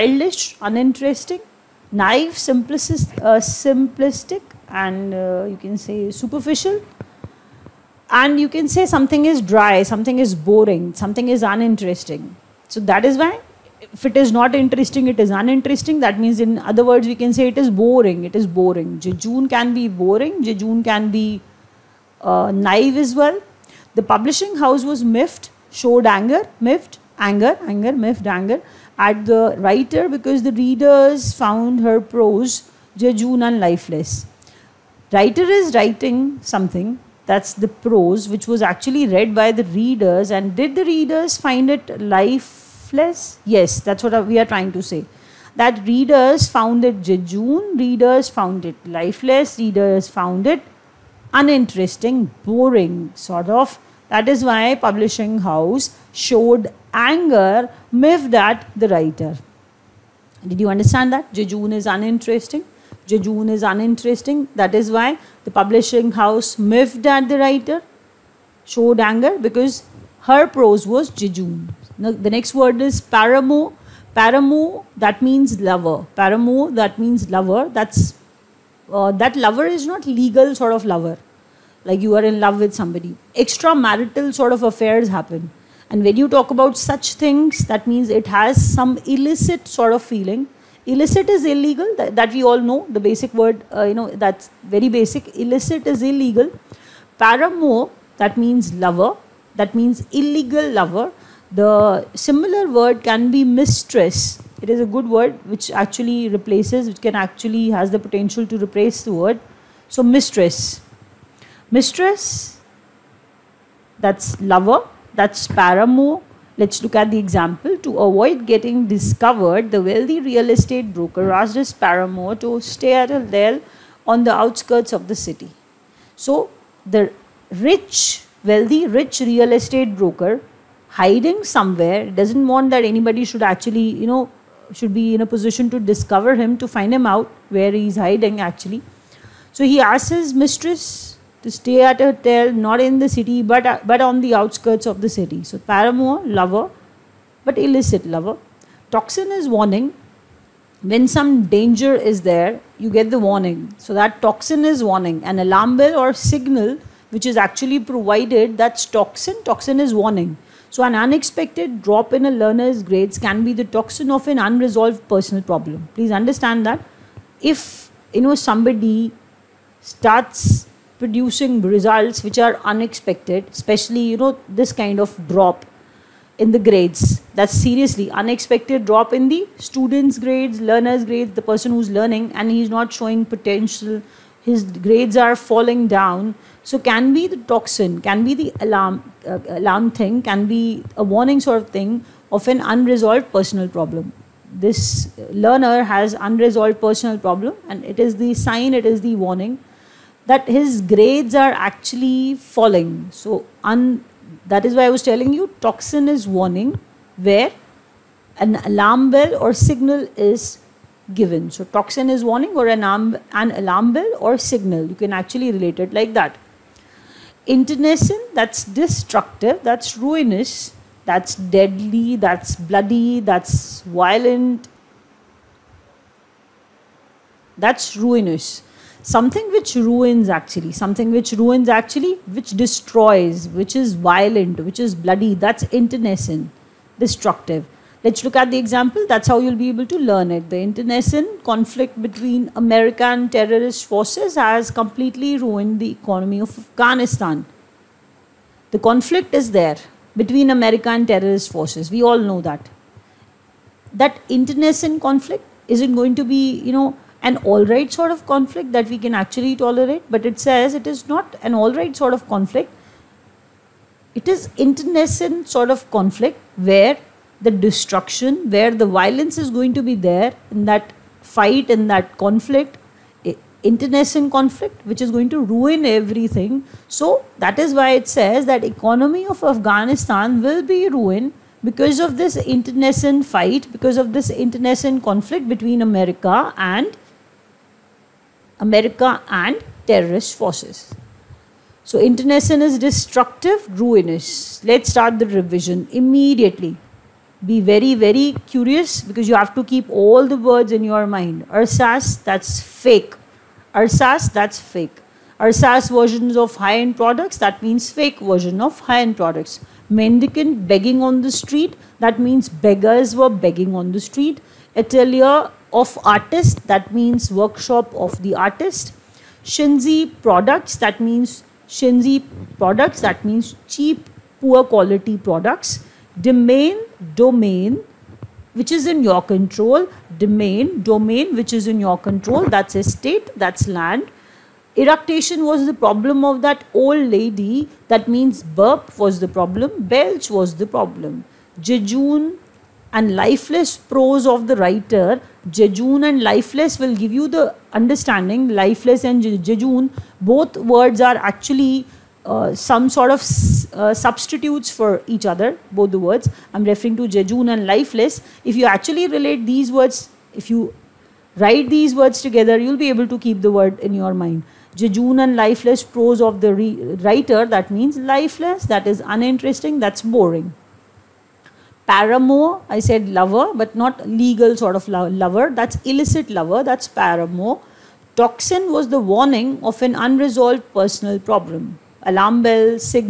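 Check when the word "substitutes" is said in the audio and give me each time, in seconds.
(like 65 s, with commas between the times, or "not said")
353 s.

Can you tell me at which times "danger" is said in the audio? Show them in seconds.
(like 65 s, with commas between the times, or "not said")
151 s.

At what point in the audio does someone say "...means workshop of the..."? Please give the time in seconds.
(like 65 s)
316 s.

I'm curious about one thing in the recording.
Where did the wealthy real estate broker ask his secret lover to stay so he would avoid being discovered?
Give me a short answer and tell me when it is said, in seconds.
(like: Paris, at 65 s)
a hotel on the outskirts of the city, at 123 s.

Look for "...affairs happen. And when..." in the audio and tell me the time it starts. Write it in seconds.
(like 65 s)
84 s.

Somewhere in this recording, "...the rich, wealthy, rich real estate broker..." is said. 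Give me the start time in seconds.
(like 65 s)
126 s.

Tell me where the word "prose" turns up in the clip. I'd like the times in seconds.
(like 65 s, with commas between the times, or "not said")
32 s, 37 s, 70 s, 343 s, 365 s.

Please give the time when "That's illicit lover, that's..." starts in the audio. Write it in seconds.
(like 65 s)
375 s.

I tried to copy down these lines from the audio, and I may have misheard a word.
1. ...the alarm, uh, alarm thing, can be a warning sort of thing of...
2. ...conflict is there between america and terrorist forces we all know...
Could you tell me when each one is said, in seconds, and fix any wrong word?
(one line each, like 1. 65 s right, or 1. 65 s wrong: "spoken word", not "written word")
1. 188 s right
2. 248 s right.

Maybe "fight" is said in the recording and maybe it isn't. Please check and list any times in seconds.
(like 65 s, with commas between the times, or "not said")
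271 s, 283 s.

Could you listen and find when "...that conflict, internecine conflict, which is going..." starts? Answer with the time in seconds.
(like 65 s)
271 s.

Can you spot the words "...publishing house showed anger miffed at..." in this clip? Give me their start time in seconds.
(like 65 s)
54 s.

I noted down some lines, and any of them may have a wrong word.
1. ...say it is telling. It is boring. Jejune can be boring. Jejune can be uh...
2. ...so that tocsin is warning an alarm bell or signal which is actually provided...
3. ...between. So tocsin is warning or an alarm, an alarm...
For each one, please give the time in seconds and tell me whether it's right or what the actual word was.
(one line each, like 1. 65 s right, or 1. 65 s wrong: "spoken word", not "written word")
1. 17 s wrong: "boring", not "telling"
2. 153 s right
3. 211 s wrong: "given", not "between".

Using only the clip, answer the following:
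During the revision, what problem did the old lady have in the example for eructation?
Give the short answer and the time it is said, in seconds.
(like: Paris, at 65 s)
burp, at 338 s.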